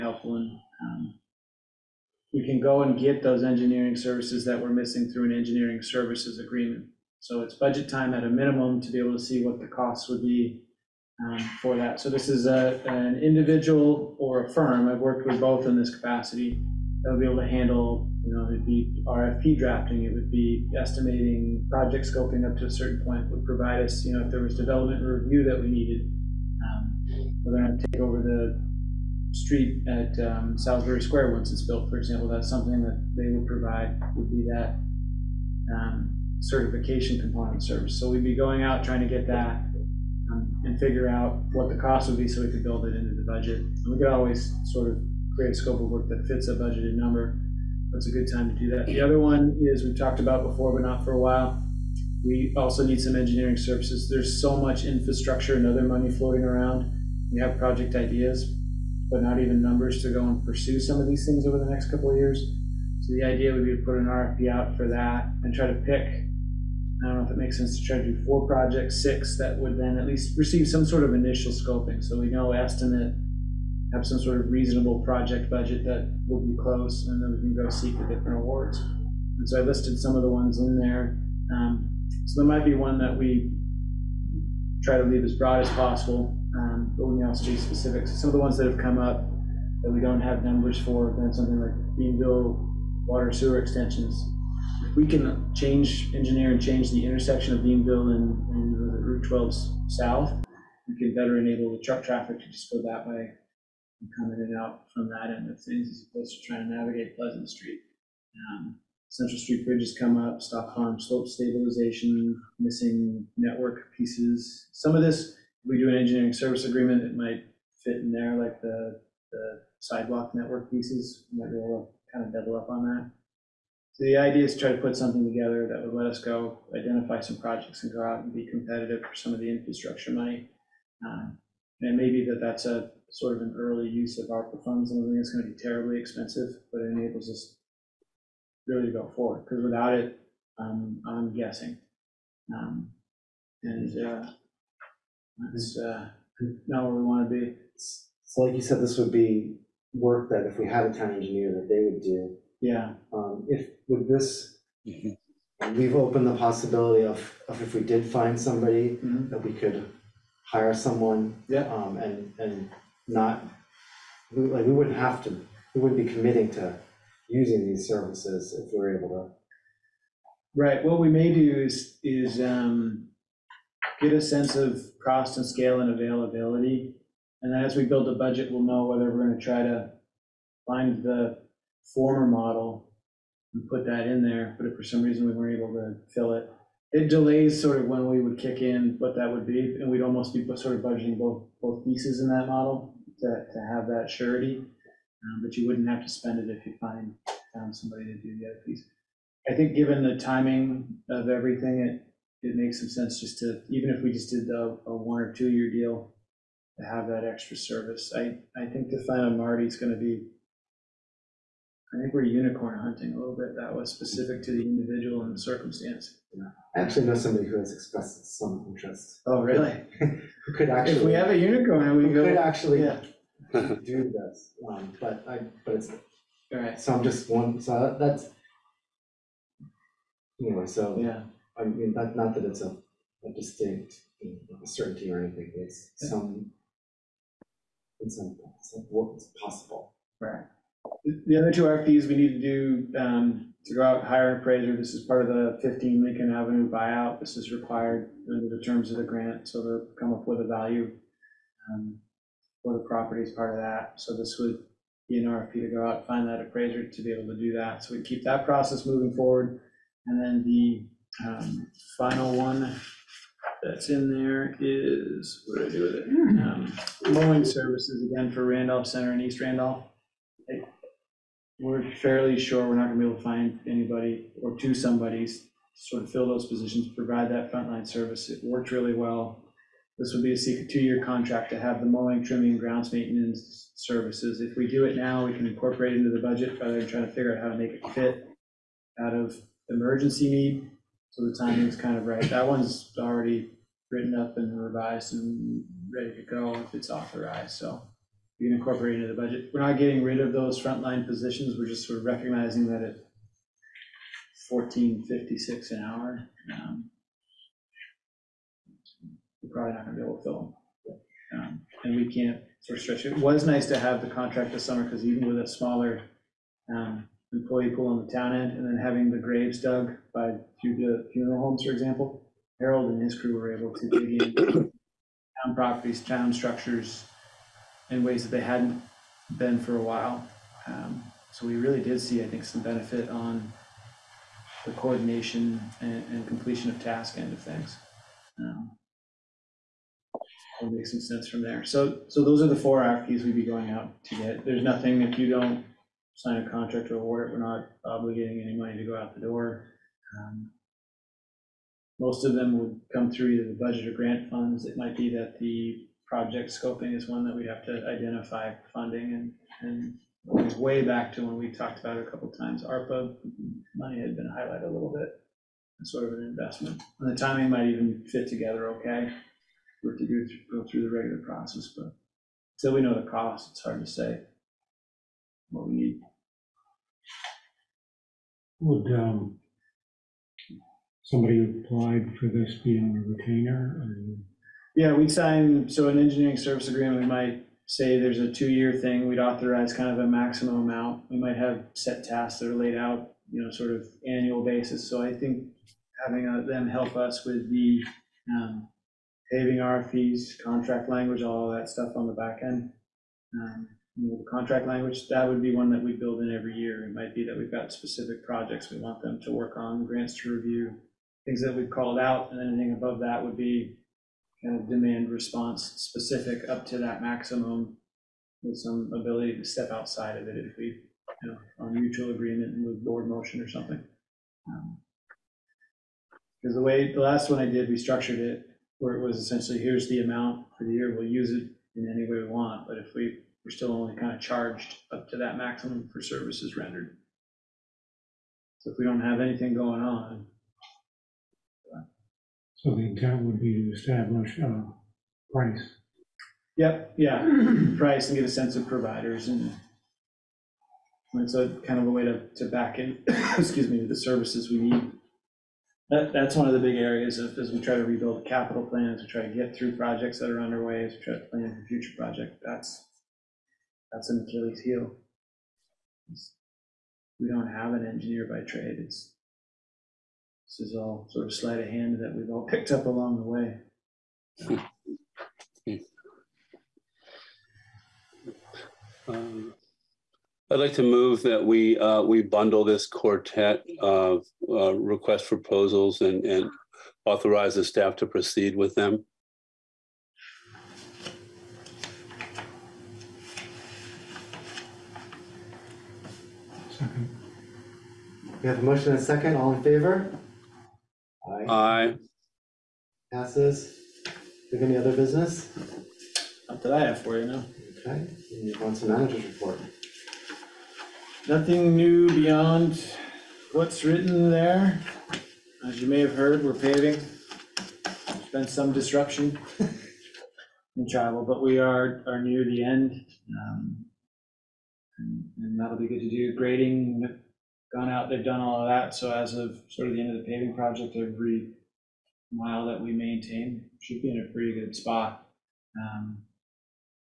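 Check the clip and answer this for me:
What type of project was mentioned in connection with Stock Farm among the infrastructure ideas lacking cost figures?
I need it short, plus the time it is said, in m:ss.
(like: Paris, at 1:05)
slope stabilization, at 1:50.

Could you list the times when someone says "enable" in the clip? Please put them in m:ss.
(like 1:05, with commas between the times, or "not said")
1:41, 2:16.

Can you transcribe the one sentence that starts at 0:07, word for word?
So it's budget time at a minimum to be able to see what the costs would be um, for that.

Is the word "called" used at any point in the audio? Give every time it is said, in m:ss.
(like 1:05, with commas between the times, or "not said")
6:51.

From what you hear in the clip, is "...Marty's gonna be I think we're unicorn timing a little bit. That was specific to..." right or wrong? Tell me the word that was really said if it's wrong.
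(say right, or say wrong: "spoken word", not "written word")
wrong: "hunting", not "timing".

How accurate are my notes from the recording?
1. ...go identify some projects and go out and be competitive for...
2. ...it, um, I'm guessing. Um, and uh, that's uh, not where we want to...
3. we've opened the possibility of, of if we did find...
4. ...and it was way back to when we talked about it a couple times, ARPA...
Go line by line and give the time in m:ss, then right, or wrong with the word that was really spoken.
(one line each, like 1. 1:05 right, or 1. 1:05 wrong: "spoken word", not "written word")
1. 2:06 right
2. 2:19 right
3. 2:35 right
4. 5:59 right.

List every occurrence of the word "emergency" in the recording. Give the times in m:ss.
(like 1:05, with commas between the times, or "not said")
4:49.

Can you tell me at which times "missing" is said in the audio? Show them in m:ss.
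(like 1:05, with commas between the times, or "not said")
0:04, 1:52.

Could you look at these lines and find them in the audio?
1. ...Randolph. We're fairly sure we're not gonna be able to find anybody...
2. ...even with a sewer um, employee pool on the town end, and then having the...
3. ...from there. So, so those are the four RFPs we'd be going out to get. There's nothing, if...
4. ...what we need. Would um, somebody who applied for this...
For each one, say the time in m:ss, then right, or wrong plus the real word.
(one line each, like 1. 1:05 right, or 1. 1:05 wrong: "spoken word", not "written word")
1. 4:29 right
2. 5:15 wrong: "smaller", not "sewer"
3. 5:41 right
4. 6:15 right.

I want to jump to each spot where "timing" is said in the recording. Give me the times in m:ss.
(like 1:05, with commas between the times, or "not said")
3:20, 4:51, 6:07.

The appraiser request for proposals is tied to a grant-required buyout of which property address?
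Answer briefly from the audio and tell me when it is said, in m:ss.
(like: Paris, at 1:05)
15 Lincoln Avenue, at 4:05.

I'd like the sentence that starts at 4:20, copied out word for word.
And then the um, final one that's in there is, what do I do with it?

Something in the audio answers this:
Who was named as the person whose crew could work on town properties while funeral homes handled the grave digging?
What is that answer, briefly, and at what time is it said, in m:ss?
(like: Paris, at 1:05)
Harold, at 5:22.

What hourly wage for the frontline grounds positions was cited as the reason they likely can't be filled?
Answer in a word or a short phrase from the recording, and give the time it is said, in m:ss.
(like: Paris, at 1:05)
$14.56, at 5:04.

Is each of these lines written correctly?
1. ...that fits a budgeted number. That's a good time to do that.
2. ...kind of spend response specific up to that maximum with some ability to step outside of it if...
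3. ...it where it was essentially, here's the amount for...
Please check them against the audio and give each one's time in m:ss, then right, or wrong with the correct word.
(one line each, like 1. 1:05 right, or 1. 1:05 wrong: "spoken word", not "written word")
1. 0:46 right
2. 6:54 wrong: "demand", not "spend"
3. 7:08 right.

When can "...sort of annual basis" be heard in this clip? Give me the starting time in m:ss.
6:33.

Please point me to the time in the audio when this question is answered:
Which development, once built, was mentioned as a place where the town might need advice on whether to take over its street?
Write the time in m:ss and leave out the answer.
0:30.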